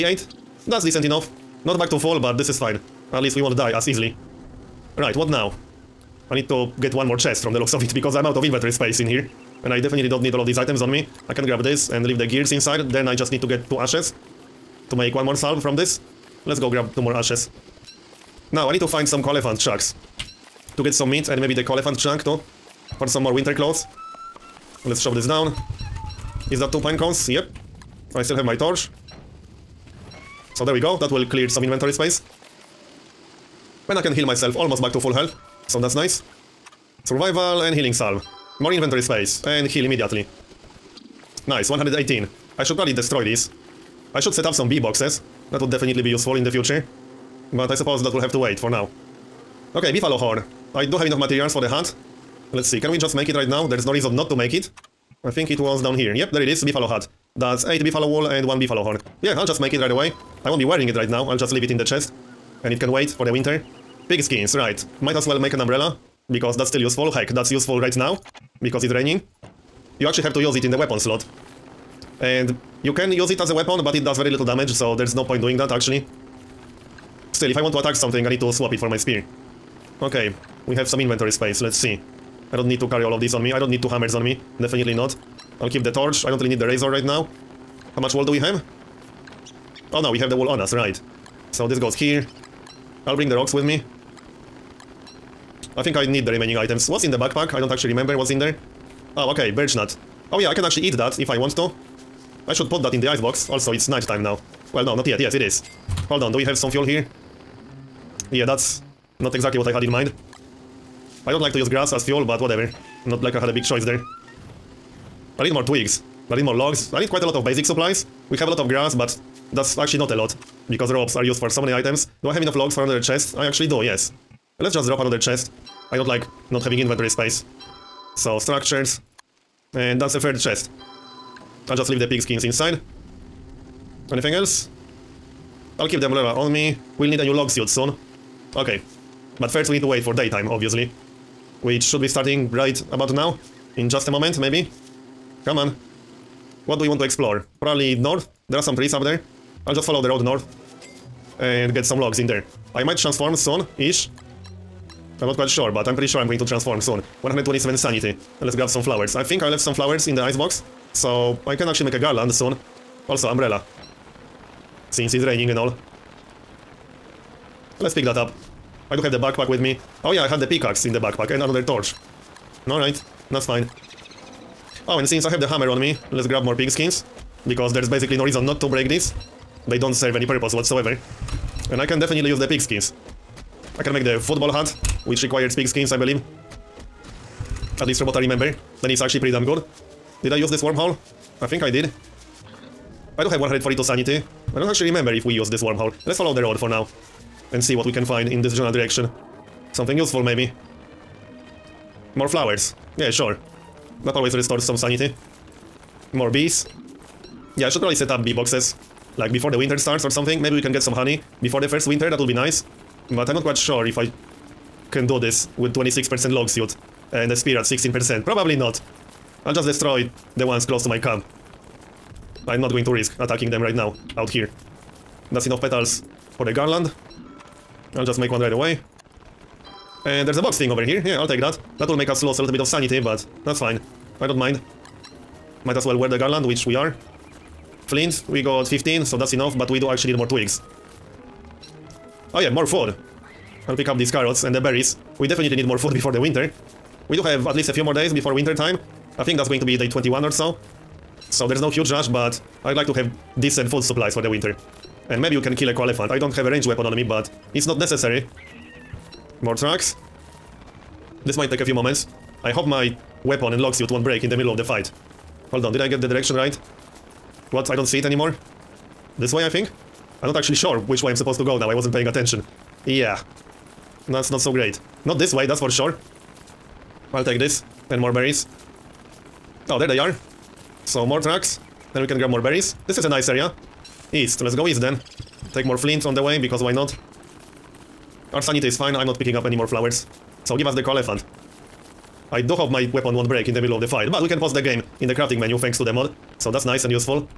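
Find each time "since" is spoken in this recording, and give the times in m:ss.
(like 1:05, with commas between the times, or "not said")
2:44, 2:55.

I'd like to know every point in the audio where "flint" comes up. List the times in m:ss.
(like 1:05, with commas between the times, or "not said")
3:57, 4:45.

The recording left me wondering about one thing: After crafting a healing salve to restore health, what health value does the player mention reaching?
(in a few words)
118.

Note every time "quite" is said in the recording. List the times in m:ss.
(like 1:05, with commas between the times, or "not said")
1:57, 2:35, 3:33.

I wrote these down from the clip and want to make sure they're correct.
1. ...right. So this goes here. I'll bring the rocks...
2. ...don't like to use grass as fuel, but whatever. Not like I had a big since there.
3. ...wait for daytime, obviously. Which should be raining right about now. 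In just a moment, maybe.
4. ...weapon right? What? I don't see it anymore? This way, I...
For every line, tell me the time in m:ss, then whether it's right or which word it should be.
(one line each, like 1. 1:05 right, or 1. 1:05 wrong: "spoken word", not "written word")
1. 1:30 right
2. 1:51 wrong: "choice", not "since"
3. 2:19 wrong: "starting", not "raining"
4. 4:26 wrong: "direction", not "weapon".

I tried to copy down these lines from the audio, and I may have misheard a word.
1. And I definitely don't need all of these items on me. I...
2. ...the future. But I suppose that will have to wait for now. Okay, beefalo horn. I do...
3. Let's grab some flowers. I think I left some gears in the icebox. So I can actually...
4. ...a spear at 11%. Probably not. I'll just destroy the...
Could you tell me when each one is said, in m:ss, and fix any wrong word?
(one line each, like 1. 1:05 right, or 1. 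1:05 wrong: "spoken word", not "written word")
1. 0:09 right
2. 0:46 right
3. 2:38 wrong: "flowers", not "gears"
4. 3:37 wrong: "16", not "11".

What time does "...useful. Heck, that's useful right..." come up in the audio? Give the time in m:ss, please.
1:06.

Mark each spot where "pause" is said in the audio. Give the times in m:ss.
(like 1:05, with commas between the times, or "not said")
4:54.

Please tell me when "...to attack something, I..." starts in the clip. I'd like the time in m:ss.
1:17.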